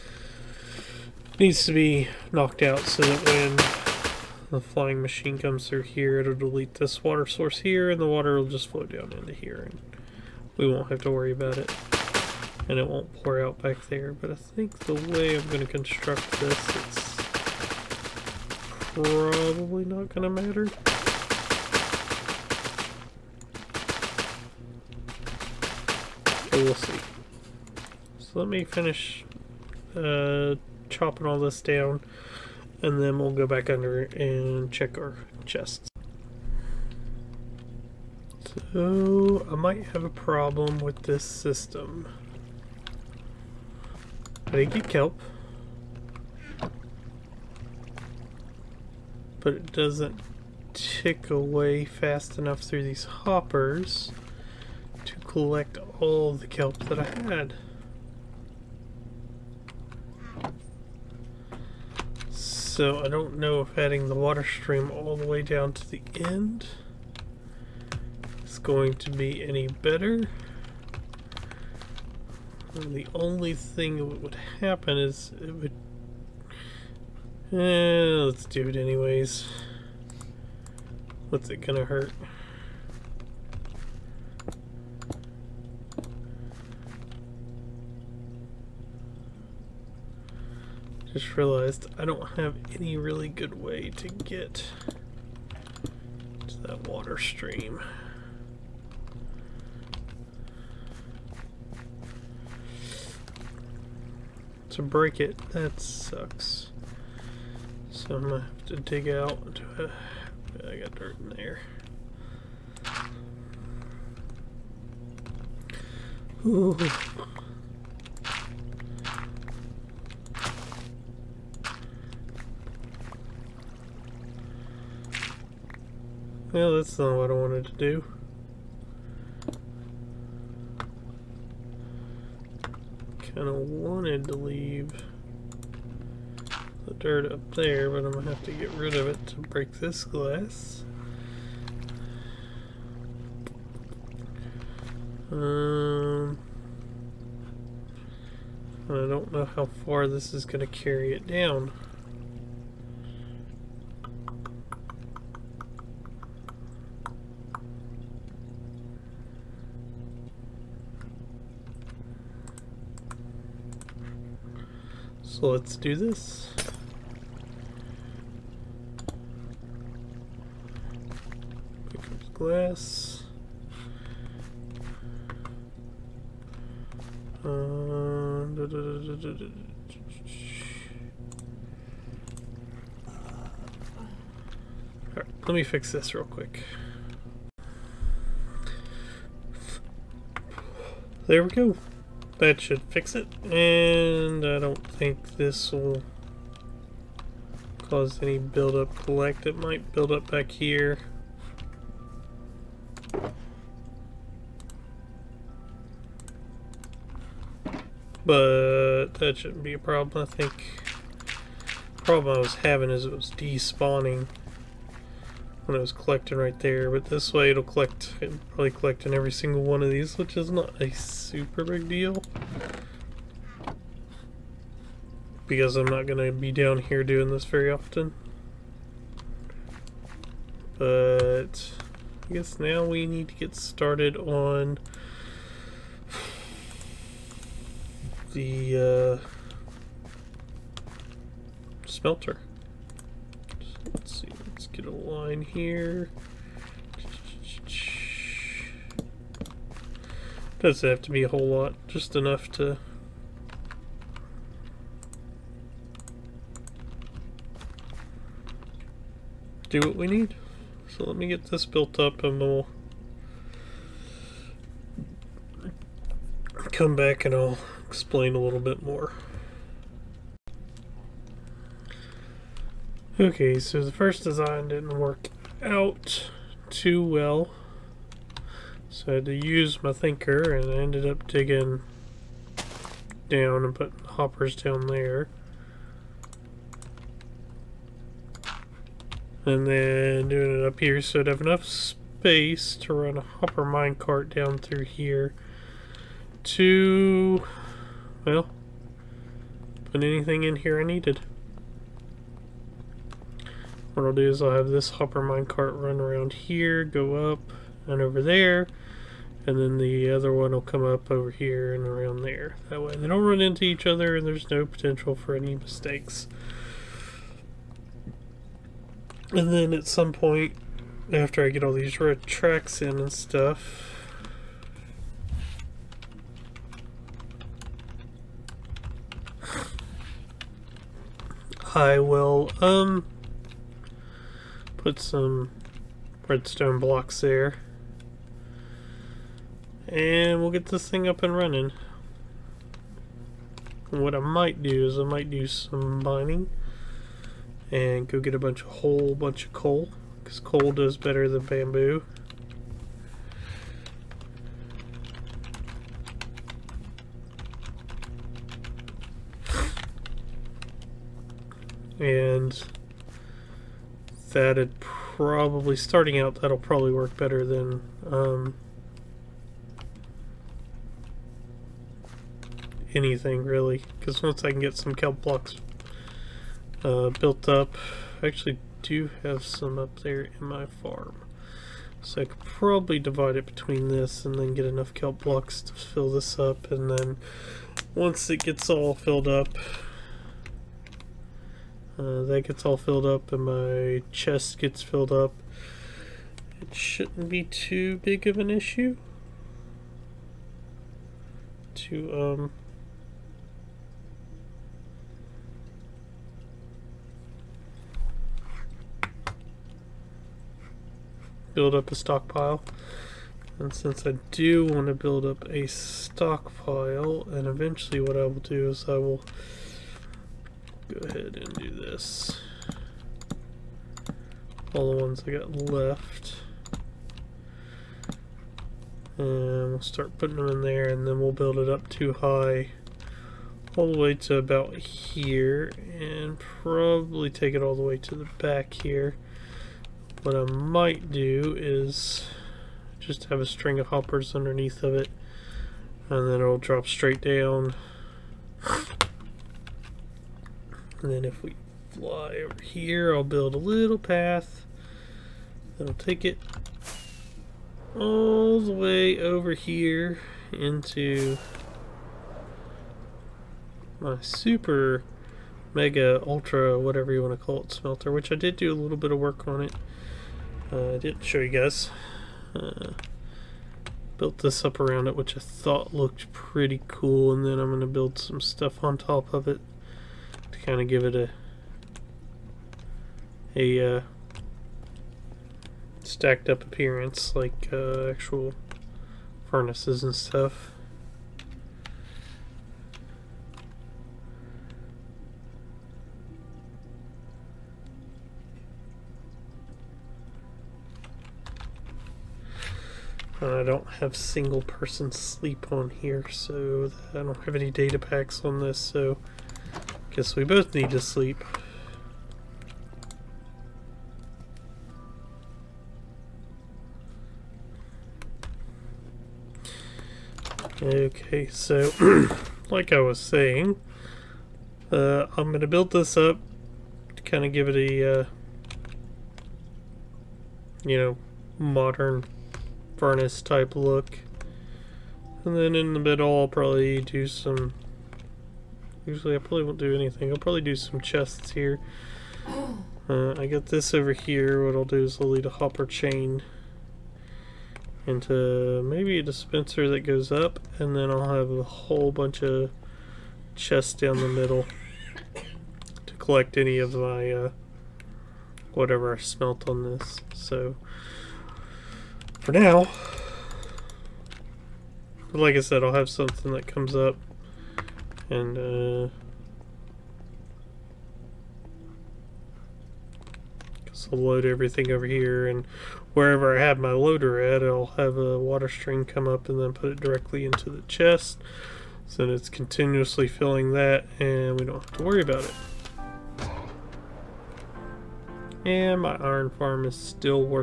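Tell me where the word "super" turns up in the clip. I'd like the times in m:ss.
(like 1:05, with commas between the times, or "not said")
3:40, 7:44.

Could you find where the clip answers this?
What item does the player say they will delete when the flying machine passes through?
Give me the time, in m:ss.
0:07.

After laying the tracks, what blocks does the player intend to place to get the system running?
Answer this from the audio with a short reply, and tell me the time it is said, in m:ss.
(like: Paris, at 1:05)
Redstone blocks, at 5:36.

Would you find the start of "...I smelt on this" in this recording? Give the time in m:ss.
9:19.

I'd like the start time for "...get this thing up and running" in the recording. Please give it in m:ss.
5:40.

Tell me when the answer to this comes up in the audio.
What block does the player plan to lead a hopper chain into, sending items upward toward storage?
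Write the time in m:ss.
9:09.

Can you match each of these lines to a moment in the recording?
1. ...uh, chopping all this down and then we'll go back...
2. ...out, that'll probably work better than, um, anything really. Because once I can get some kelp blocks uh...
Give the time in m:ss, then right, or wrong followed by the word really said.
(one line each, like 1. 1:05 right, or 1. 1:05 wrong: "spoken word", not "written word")
1. 0:29 right
2. 6:06 right.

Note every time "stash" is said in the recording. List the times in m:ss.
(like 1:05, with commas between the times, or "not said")
not said.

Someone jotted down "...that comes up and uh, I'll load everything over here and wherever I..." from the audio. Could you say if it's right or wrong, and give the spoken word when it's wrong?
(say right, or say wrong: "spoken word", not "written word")
right.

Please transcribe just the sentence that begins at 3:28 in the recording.
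But that shouldn't be a problem.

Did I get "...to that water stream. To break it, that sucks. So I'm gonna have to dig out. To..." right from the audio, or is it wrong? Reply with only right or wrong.
right.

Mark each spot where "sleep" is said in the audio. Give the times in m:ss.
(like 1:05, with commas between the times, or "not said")
8:25, 8:30.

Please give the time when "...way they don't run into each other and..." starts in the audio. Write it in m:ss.
5:12.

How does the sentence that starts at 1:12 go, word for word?
And the only thing that would happen is it would...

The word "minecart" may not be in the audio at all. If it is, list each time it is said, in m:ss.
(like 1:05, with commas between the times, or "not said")
4:53, 5:05.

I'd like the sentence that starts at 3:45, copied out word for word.
Because I'm not going to be down here doing this very often.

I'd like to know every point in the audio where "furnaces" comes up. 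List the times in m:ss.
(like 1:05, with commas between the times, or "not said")
8:09, 8:52.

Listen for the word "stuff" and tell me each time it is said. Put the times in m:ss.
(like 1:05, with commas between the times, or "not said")
5:23, 7:58, 8:10.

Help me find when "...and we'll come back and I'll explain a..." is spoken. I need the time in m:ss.
4:22.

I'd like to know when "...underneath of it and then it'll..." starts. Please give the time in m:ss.
7:24.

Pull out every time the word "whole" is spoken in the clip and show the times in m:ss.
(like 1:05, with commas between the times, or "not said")
4:11, 5:48, 9:11.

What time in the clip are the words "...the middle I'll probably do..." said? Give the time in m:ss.
8:55.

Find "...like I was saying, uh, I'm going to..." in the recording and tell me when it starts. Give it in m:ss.
8:42.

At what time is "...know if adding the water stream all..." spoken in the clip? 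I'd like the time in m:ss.
1:03.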